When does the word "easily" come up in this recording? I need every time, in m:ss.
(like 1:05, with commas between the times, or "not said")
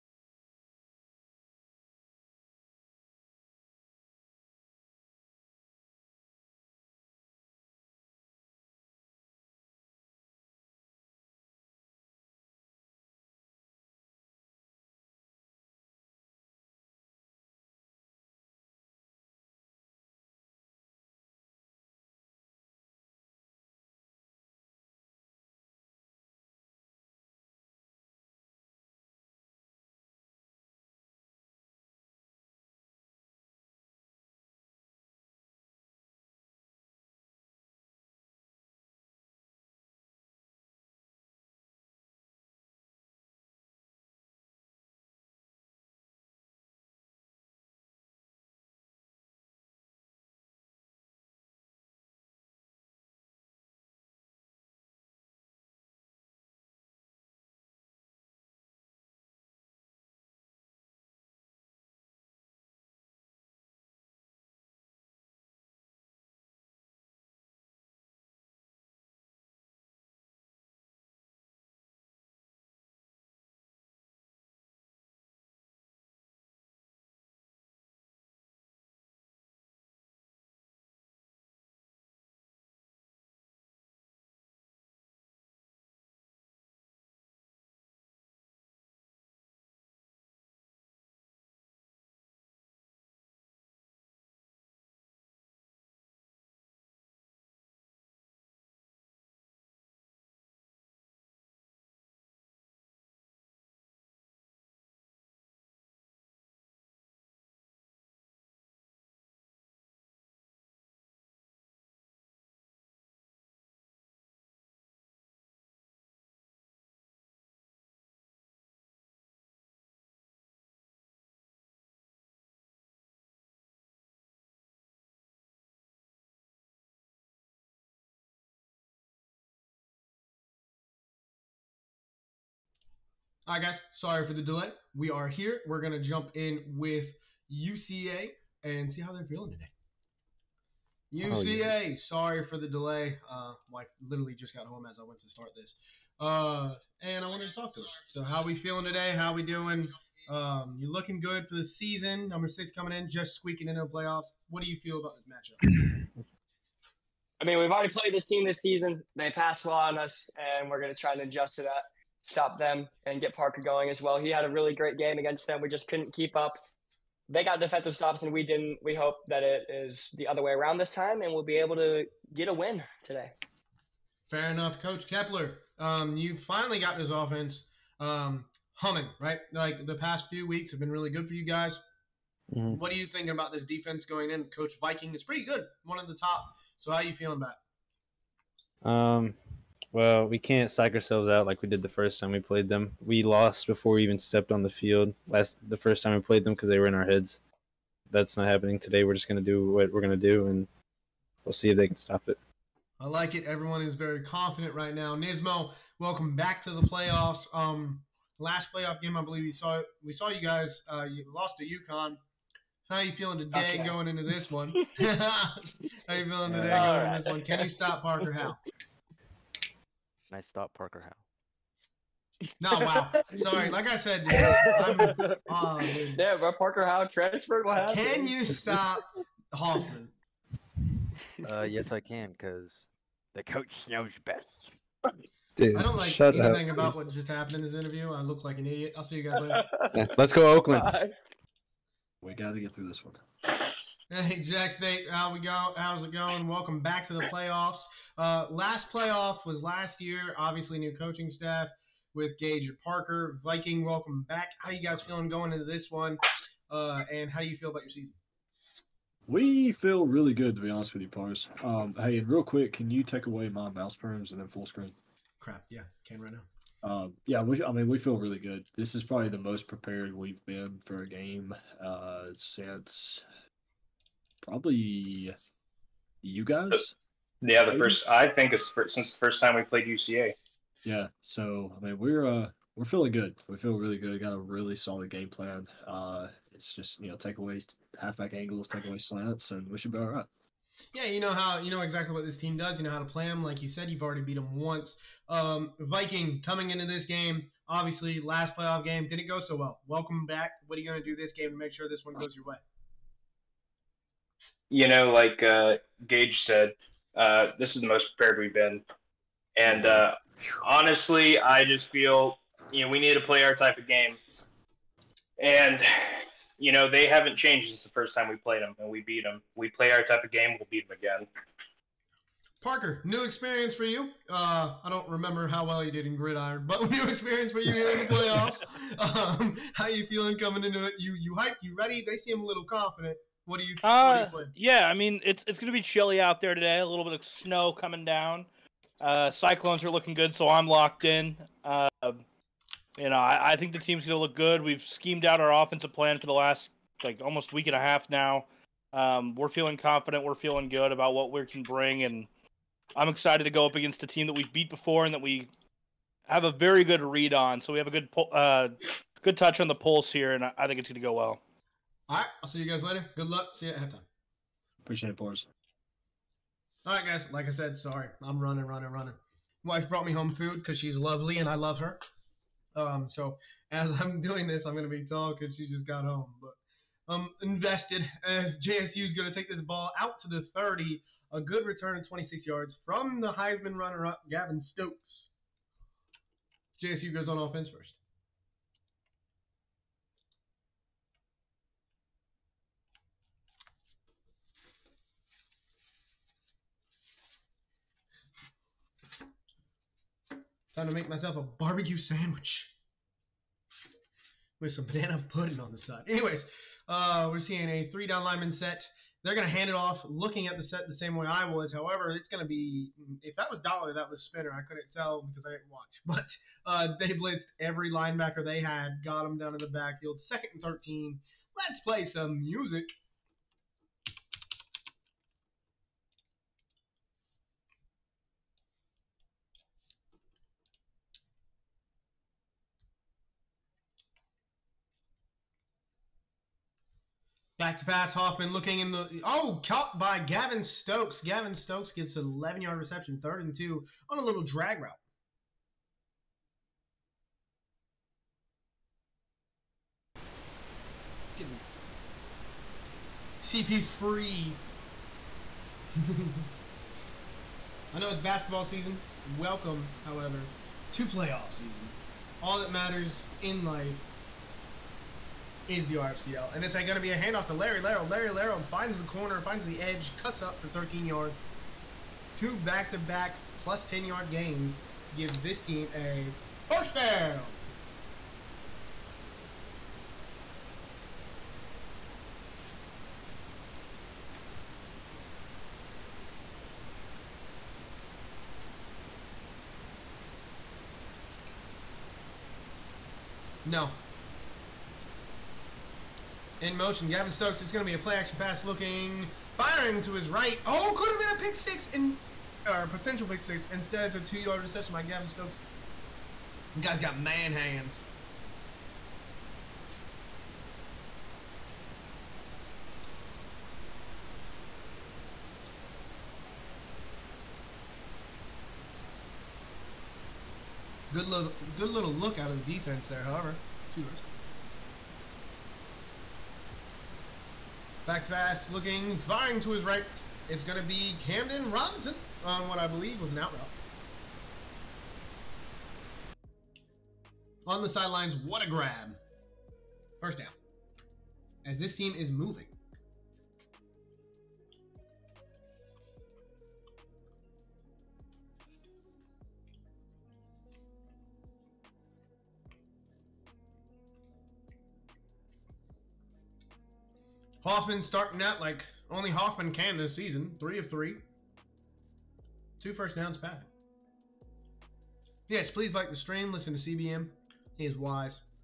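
not said.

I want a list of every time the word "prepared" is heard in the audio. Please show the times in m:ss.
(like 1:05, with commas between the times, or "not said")
4:29, 5:08.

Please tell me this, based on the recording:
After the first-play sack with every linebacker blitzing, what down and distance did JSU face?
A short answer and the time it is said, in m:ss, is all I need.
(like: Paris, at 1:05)
Second and 13, at 7:00.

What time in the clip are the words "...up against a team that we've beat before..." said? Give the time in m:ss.
5:53.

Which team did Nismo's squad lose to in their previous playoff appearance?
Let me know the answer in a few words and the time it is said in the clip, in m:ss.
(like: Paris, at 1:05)
UConn, at 3:31.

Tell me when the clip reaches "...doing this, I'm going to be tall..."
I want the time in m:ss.
6:14.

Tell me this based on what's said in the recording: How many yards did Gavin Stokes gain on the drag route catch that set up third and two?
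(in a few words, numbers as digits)
11.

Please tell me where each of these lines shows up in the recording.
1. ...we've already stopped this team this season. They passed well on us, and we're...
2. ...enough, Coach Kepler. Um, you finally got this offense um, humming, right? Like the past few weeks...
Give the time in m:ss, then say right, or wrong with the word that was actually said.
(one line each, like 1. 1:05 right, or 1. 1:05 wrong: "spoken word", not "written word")
1. 2:37 wrong: "played", not "stopped"
2. 2:54 right.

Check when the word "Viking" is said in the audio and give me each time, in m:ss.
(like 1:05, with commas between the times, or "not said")
3:04, 4:13, 4:55.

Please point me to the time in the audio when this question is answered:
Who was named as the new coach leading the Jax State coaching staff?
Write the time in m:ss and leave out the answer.
4:12.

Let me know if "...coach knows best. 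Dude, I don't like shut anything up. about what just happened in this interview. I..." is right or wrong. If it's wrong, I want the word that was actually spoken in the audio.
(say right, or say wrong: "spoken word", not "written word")
right.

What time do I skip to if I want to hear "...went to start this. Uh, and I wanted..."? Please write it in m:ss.
2:25.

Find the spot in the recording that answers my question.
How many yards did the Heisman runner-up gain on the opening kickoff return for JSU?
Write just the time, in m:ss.
6:22.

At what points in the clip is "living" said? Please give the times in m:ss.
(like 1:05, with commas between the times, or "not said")
not said.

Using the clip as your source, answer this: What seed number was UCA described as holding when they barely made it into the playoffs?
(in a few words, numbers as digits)
6.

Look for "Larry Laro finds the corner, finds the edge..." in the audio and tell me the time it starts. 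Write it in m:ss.
7:48.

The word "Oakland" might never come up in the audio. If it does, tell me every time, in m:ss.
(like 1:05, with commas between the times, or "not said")
4:00.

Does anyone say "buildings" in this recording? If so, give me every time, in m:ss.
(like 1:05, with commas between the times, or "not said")
not said.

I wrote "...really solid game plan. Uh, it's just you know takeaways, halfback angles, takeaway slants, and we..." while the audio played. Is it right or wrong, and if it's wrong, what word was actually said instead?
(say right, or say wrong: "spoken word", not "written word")
right.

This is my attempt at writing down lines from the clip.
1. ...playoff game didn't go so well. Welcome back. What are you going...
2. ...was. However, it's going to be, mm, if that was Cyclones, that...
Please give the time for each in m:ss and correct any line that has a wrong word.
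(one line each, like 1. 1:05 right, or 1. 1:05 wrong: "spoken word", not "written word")
1. 4:58 right
2. 6:51 wrong: "Dollar", not "Cyclones".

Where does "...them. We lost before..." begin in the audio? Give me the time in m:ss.
3:12.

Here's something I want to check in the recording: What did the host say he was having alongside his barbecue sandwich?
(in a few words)
banana pudding.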